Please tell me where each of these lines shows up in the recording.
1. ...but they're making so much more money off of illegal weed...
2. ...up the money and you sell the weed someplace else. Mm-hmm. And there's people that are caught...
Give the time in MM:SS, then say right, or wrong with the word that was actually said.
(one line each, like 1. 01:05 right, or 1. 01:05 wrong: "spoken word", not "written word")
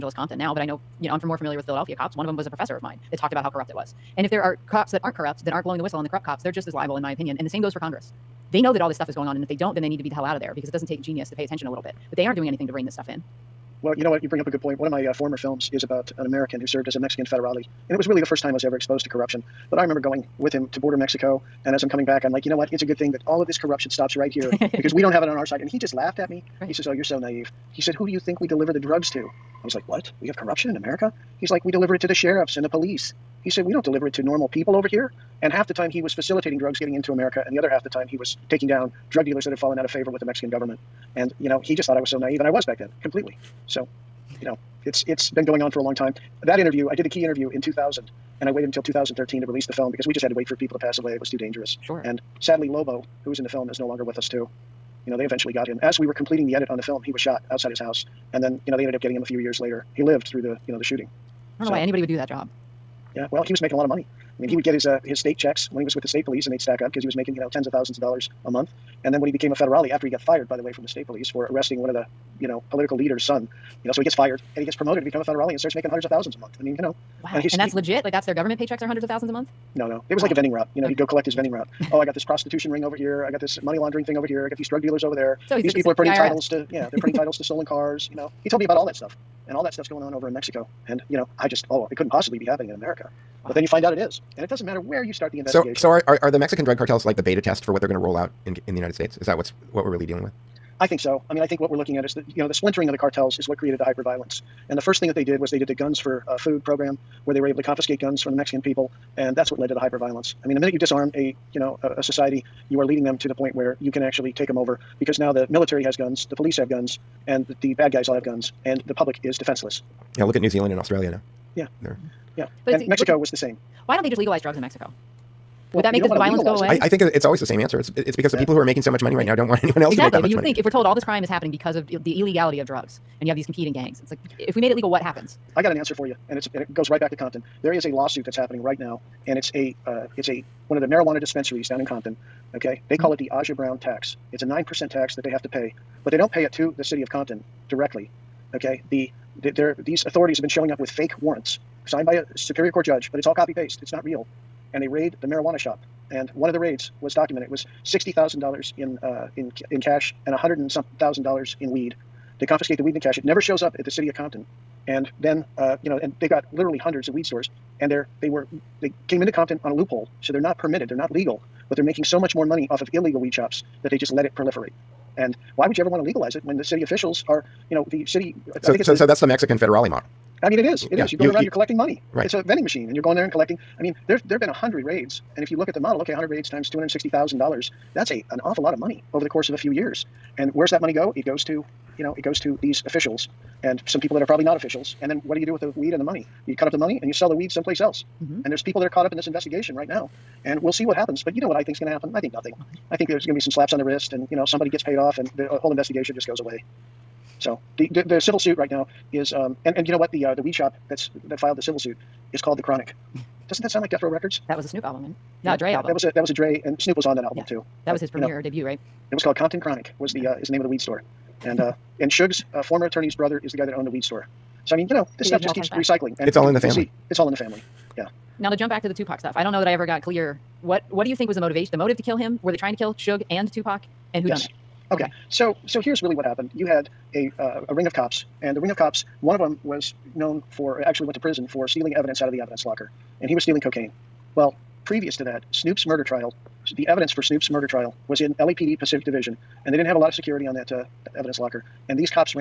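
1. 02:51 right
2. 03:16 right.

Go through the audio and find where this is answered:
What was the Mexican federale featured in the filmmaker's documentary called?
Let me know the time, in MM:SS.
00:52.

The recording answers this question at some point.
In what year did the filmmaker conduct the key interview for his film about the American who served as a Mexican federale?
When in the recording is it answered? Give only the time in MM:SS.
00:47.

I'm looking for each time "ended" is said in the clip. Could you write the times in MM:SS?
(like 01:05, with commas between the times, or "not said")
00:58.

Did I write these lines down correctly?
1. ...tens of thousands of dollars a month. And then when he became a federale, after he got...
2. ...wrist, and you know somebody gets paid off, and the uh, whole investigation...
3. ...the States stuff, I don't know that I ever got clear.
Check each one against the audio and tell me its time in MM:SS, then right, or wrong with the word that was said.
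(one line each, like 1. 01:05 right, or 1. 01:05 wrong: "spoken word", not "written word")
1. 01:07 right
2. 03:23 right
3. 03:48 wrong: "Tupac", not "States".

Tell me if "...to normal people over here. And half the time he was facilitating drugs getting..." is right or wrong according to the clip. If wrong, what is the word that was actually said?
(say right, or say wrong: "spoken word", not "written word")
right.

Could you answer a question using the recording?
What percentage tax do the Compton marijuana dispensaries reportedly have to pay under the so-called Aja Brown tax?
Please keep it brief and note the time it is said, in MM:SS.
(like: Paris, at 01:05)
9 percent, at 02:24.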